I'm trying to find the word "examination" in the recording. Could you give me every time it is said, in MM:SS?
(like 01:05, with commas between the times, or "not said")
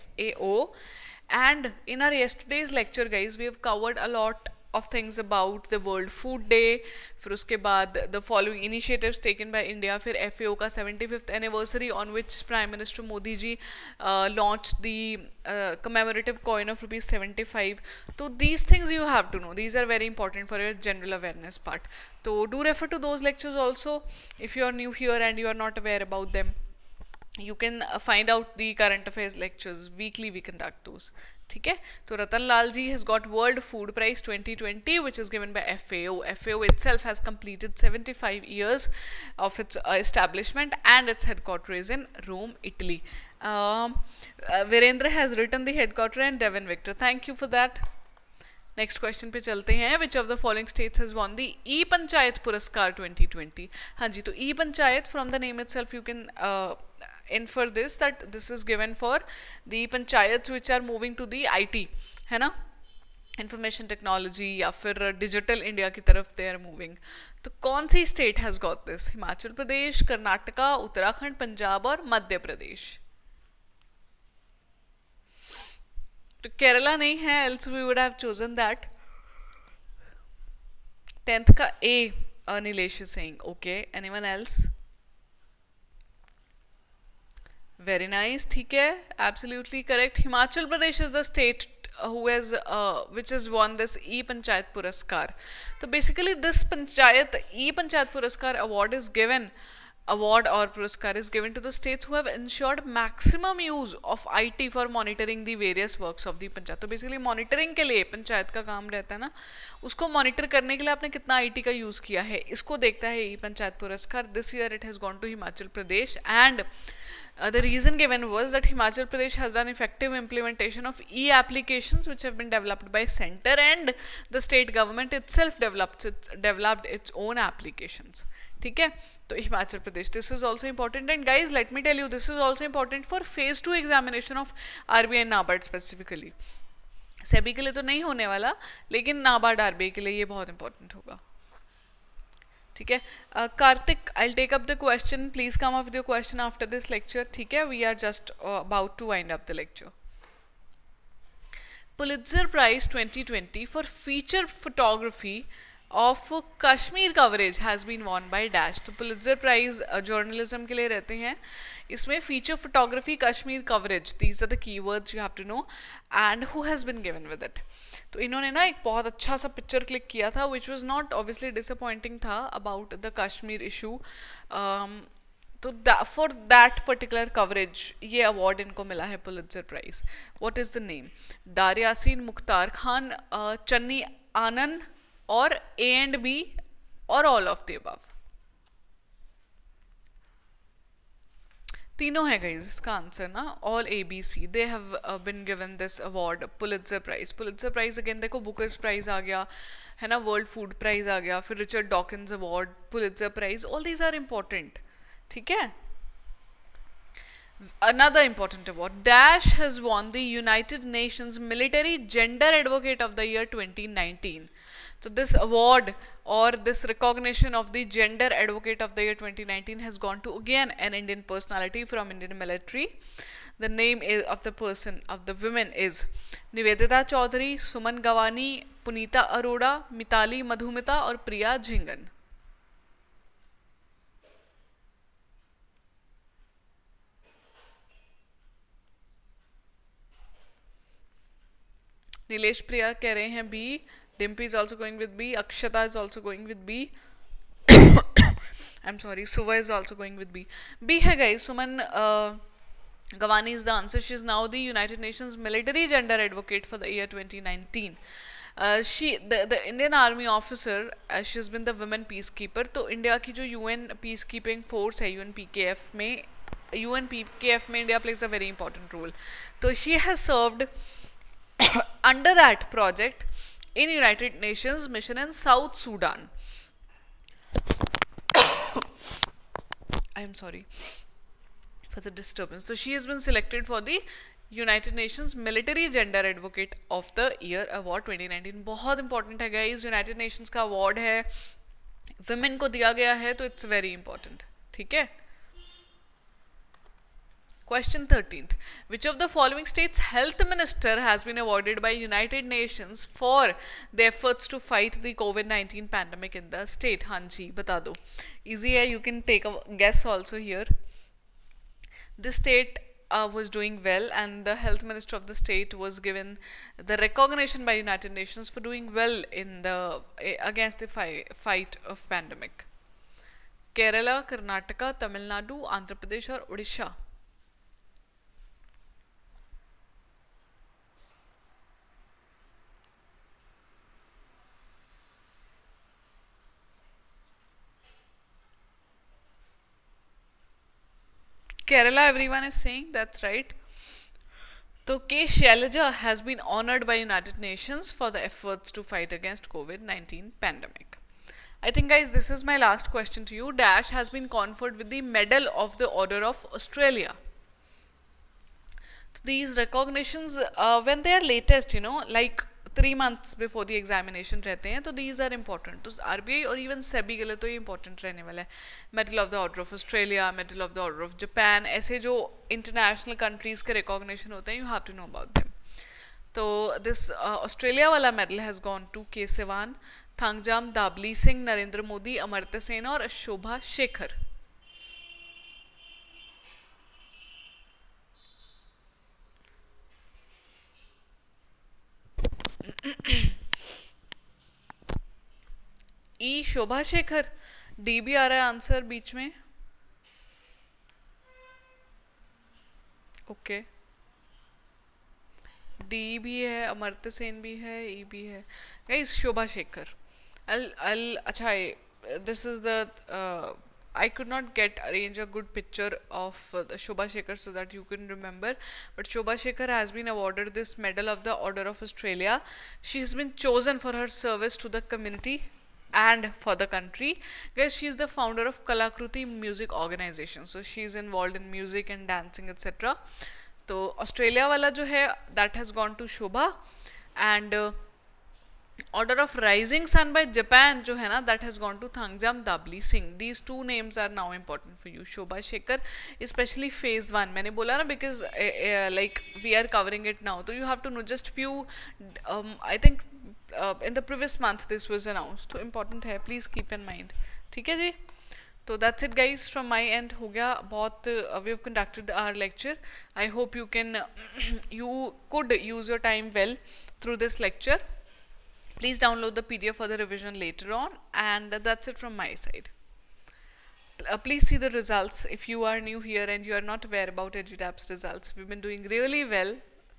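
not said.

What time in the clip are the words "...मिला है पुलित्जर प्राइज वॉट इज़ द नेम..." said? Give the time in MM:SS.
02:58.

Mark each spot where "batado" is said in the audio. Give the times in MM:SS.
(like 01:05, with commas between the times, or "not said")
05:07.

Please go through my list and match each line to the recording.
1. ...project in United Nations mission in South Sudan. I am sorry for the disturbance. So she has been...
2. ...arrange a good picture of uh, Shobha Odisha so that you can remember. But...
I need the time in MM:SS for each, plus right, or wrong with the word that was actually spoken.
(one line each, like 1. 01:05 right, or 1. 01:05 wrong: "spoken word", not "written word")
1. 04:32 right
2. 06:54 wrong: "Shekhar", not "Odisha".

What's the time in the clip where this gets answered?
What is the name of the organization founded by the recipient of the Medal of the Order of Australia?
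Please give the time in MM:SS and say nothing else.
07:08.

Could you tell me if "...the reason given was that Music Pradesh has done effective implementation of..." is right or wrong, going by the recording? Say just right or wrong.
wrong.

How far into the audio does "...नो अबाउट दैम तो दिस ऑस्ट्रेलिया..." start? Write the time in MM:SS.
06:14.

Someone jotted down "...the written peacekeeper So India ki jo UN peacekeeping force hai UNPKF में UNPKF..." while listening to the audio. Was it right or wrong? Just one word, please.
wrong.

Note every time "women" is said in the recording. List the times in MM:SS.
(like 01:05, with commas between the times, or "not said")
03:45, 04:21.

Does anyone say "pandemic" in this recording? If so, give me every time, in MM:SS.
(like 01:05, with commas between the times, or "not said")
05:05, 05:22, 05:50.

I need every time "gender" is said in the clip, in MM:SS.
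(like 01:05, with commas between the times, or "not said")
03:32, 03:37, 04:15.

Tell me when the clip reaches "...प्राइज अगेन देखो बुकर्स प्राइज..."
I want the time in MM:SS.
03:17.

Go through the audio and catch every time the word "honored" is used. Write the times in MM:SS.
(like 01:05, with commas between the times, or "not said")
05:46.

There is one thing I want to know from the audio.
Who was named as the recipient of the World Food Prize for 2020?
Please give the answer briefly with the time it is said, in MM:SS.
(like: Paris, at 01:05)
Ratan Lal, at 00:32.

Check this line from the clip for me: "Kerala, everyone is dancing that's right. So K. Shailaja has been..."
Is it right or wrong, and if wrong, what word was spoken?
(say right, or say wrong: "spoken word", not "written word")
wrong: "saying", not "dancing".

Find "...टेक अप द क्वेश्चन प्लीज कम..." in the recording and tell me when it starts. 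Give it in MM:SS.
02:24.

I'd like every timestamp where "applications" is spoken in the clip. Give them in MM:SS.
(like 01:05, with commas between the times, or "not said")
02:01, 02:07.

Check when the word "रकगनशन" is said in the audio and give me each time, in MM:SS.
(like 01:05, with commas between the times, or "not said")
06:13.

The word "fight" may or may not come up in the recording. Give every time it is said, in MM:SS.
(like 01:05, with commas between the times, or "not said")
05:04, 05:21, 05:48.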